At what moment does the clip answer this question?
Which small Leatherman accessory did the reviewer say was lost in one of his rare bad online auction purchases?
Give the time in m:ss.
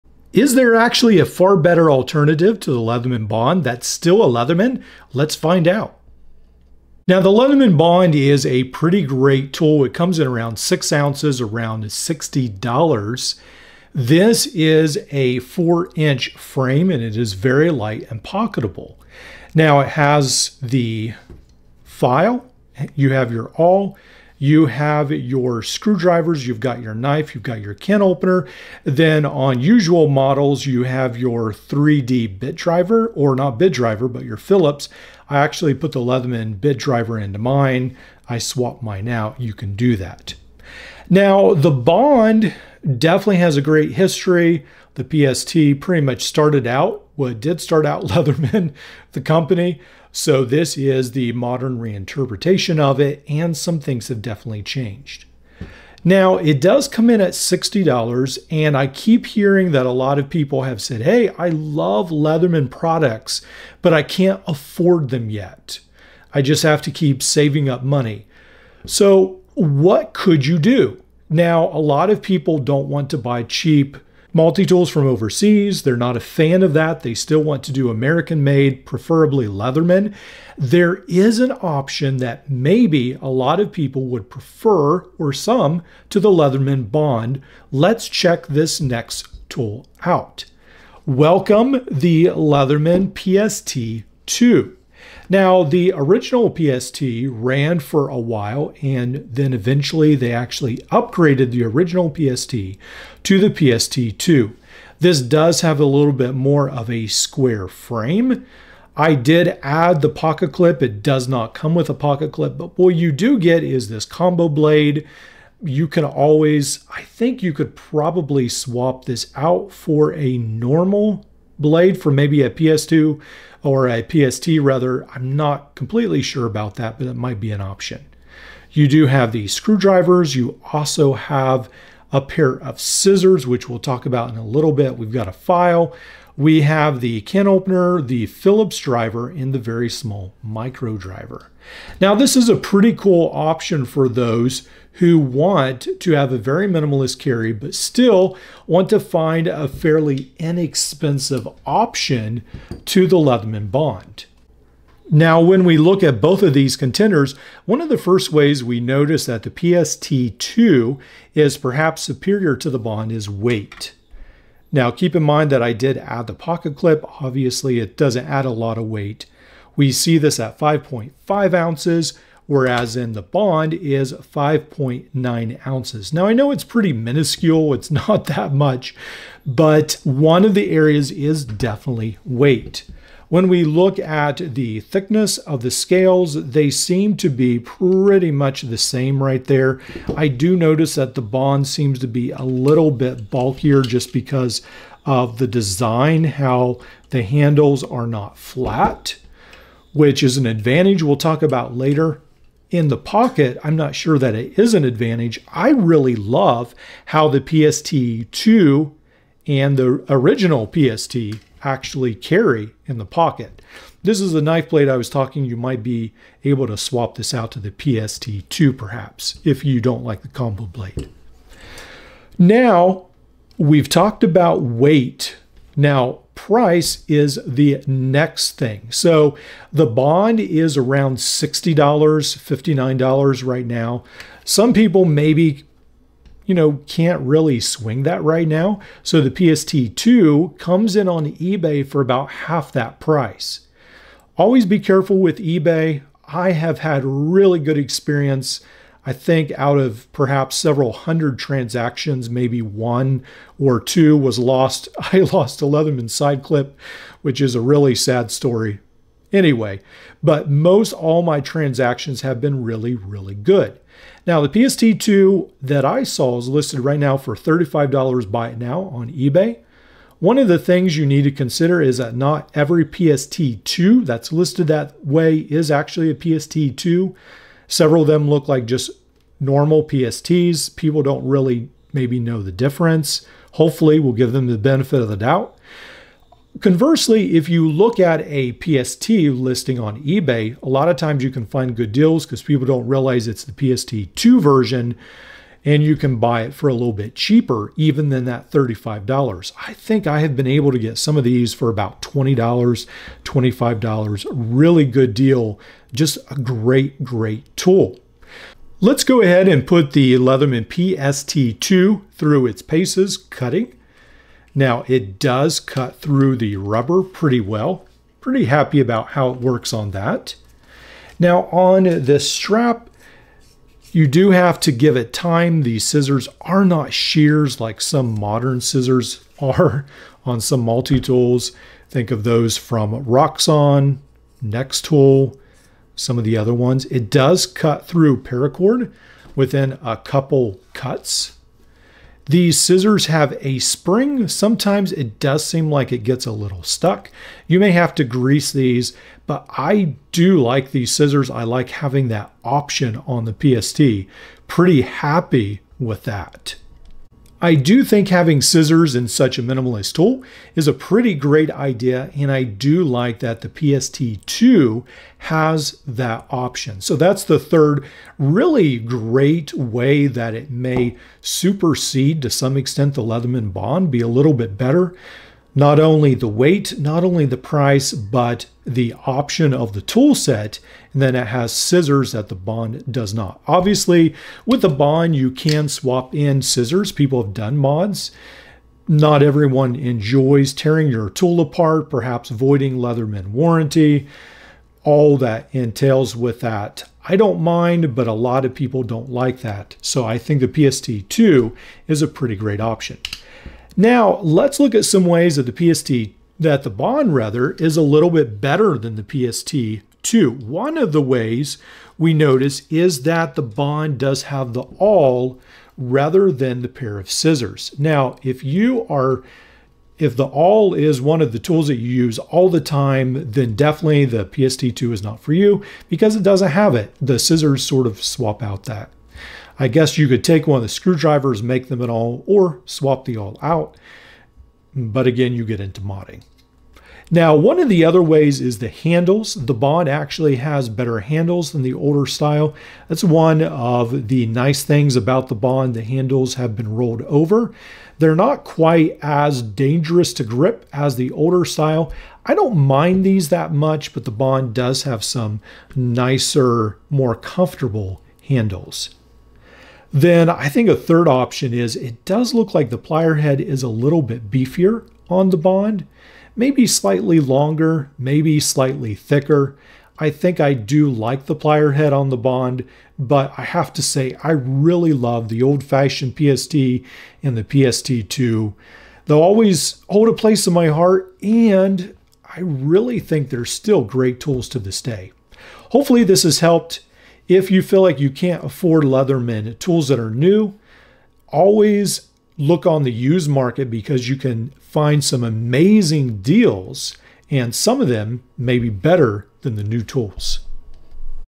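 4:16.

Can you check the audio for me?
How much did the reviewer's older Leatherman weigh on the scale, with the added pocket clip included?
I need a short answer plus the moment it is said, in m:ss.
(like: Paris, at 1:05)
5.5 ounces, at 2:50.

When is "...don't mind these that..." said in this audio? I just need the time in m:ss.
7:32.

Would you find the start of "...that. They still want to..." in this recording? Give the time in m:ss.
1:16.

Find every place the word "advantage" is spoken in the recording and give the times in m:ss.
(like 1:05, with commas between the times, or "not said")
3:20, 3:24.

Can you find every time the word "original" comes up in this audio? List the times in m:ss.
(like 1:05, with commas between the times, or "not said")
1:35, 1:41, 3:30.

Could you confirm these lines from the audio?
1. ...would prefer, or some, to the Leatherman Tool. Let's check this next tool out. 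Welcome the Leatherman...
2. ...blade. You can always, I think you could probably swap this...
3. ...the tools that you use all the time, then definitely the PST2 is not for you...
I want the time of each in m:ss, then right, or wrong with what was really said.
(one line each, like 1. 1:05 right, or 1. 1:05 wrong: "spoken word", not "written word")
1. 1:24 wrong: "Bond", not "Tool"
2. 1:54 right
3. 7:01 right.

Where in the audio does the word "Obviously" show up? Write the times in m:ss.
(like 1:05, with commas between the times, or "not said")
2:47, 6:23.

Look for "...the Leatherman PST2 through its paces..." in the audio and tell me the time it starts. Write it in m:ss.
5:09.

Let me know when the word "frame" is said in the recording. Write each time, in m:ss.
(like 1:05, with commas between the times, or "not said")
0:16, 1:47.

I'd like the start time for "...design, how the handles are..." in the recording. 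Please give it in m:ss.
3:15.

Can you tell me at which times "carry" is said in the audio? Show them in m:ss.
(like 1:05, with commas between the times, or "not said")
2:27, 3:32.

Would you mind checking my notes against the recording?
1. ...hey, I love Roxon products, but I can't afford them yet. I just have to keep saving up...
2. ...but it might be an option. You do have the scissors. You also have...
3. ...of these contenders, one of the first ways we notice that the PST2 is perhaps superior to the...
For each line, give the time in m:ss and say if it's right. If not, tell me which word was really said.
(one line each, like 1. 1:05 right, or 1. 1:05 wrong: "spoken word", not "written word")
1. 1:01 wrong: "Leatherman", not "Roxon"
2. 2:06 wrong: "screwdrivers", not "scissors"
3. 2:36 right.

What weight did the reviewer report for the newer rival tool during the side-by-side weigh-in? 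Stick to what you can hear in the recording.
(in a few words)
5.9 ounces.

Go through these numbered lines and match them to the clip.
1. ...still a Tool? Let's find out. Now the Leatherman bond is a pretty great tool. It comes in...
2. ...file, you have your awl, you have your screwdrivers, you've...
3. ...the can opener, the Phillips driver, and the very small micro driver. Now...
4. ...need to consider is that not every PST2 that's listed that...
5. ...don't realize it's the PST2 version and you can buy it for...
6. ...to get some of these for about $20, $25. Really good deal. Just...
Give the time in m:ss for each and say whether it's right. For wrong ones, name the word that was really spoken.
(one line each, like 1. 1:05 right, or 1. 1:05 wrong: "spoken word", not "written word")
1. 0:03 wrong: "Leatherman", not "Tool"
2. 0:21 right
3. 2:17 right
4. 4:31 right
5. 4:52 right
6. 5:00 right.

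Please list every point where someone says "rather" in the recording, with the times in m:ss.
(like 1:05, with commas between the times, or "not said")
2:04, 6:47, 6:55.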